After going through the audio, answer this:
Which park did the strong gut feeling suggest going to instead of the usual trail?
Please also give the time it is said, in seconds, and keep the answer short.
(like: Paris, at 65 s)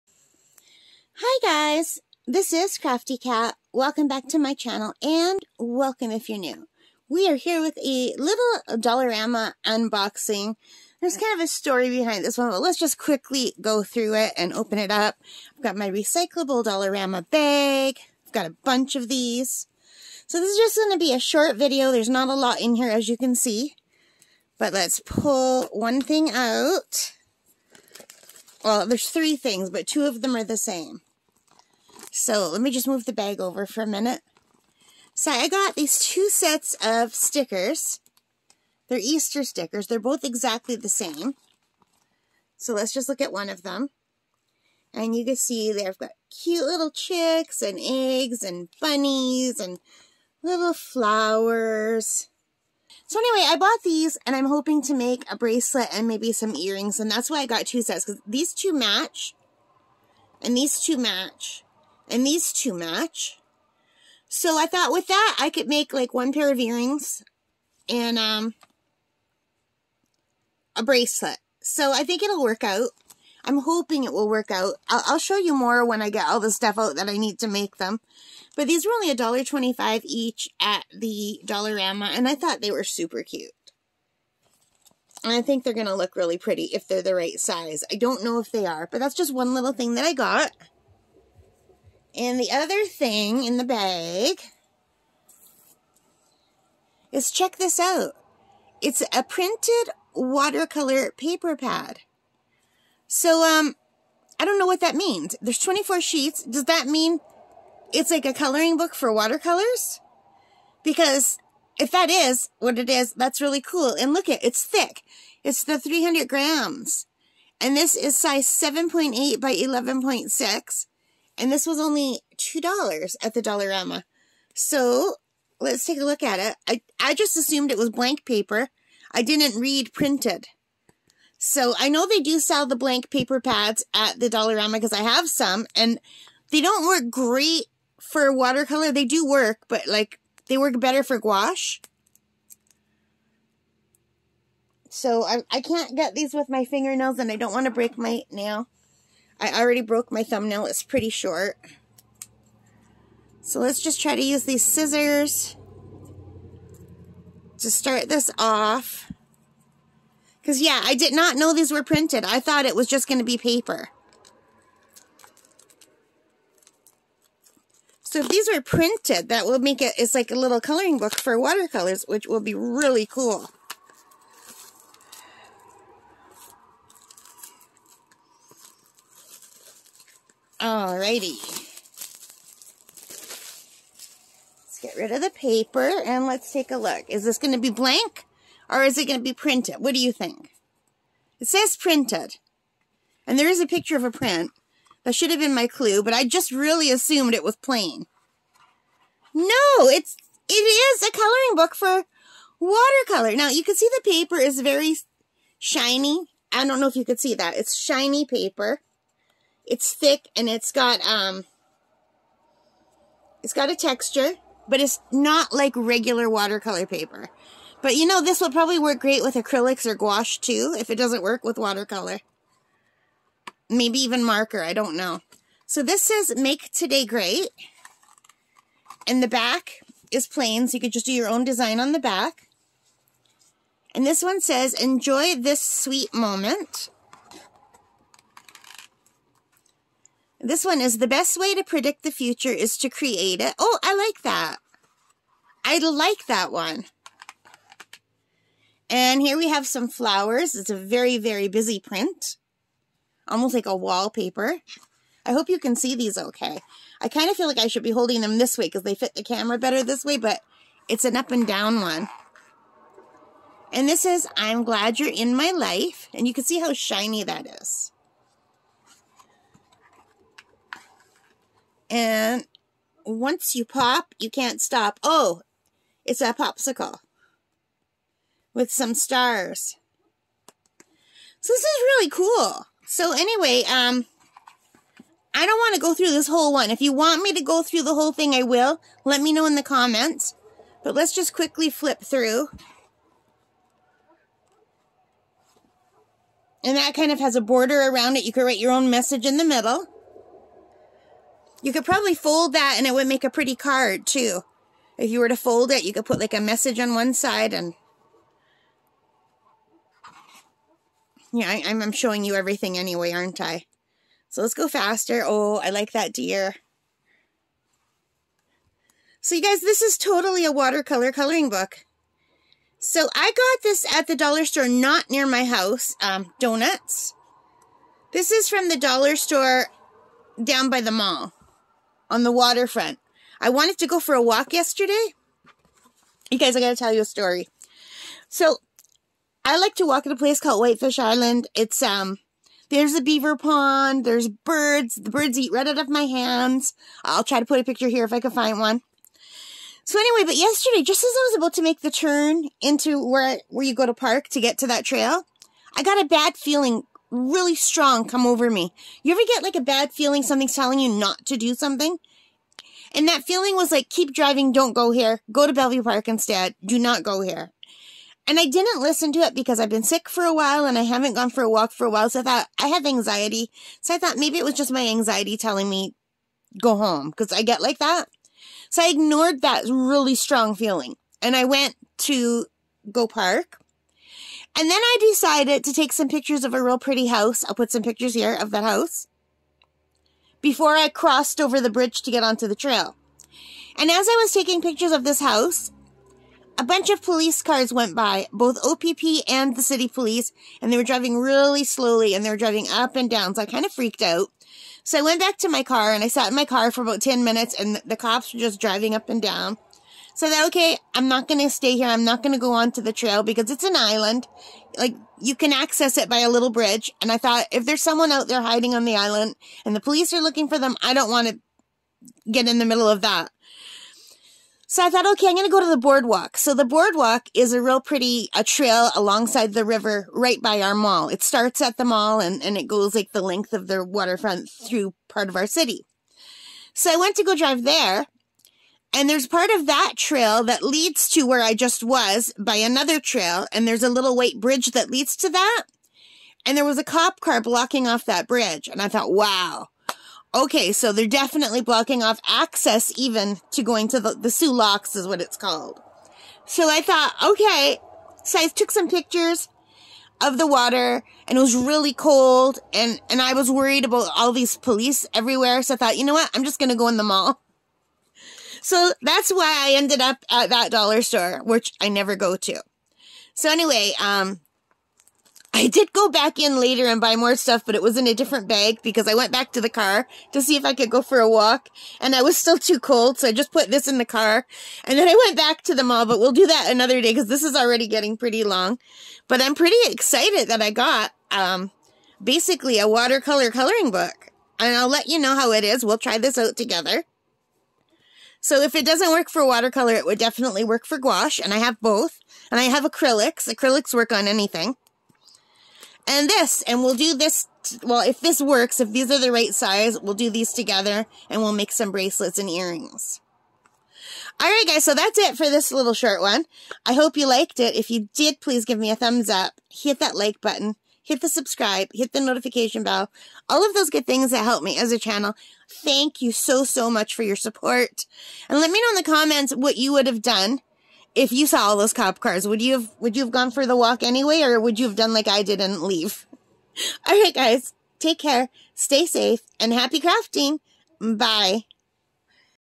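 Bellevue Park, at 365 s.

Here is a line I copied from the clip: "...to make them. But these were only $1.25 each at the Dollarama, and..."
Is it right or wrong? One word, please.
right.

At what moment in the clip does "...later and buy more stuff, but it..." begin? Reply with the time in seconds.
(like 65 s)
476 s.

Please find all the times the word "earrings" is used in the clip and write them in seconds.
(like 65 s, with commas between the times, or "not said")
56 s, 66 s, 512 s.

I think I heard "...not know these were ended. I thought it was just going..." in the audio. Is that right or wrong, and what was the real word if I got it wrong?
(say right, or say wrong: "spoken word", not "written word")
wrong: "printed", not "ended".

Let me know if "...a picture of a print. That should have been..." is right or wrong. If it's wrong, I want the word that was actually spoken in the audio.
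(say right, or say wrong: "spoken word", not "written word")
right.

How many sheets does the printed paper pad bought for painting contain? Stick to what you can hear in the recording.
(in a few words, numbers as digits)
24.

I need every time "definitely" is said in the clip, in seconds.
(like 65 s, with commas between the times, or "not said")
451 s, 500 s.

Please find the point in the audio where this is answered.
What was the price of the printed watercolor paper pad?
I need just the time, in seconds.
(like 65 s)
122 s.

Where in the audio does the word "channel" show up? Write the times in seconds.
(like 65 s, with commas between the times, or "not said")
4 s, 524 s.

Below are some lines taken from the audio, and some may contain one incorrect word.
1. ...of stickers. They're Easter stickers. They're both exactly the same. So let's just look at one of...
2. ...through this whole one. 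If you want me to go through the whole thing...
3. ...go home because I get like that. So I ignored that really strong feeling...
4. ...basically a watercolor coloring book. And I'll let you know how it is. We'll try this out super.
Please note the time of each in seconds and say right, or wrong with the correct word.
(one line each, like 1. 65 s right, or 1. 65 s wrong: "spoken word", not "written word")
1. 36 s right
2. 285 s right
3. 376 s right
4. 492 s wrong: "together", not "super".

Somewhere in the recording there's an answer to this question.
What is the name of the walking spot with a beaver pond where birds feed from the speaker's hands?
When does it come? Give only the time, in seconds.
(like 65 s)
340 s.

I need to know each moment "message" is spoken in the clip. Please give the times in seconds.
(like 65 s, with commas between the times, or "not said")
298 s, 306 s.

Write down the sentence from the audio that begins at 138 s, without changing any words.
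They do work, but like they work better for gouache.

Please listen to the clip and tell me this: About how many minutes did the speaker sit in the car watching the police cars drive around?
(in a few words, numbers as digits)
10.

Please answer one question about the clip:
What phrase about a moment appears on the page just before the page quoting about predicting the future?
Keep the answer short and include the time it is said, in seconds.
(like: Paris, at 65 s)
Enjoy this sweet moment, at 234 s.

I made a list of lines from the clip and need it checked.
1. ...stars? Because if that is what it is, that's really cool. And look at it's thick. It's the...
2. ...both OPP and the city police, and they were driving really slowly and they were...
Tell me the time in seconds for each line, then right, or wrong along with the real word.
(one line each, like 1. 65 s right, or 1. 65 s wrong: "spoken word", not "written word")
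1. 109 s wrong: "watercolors", not "stars"
2. 398 s right.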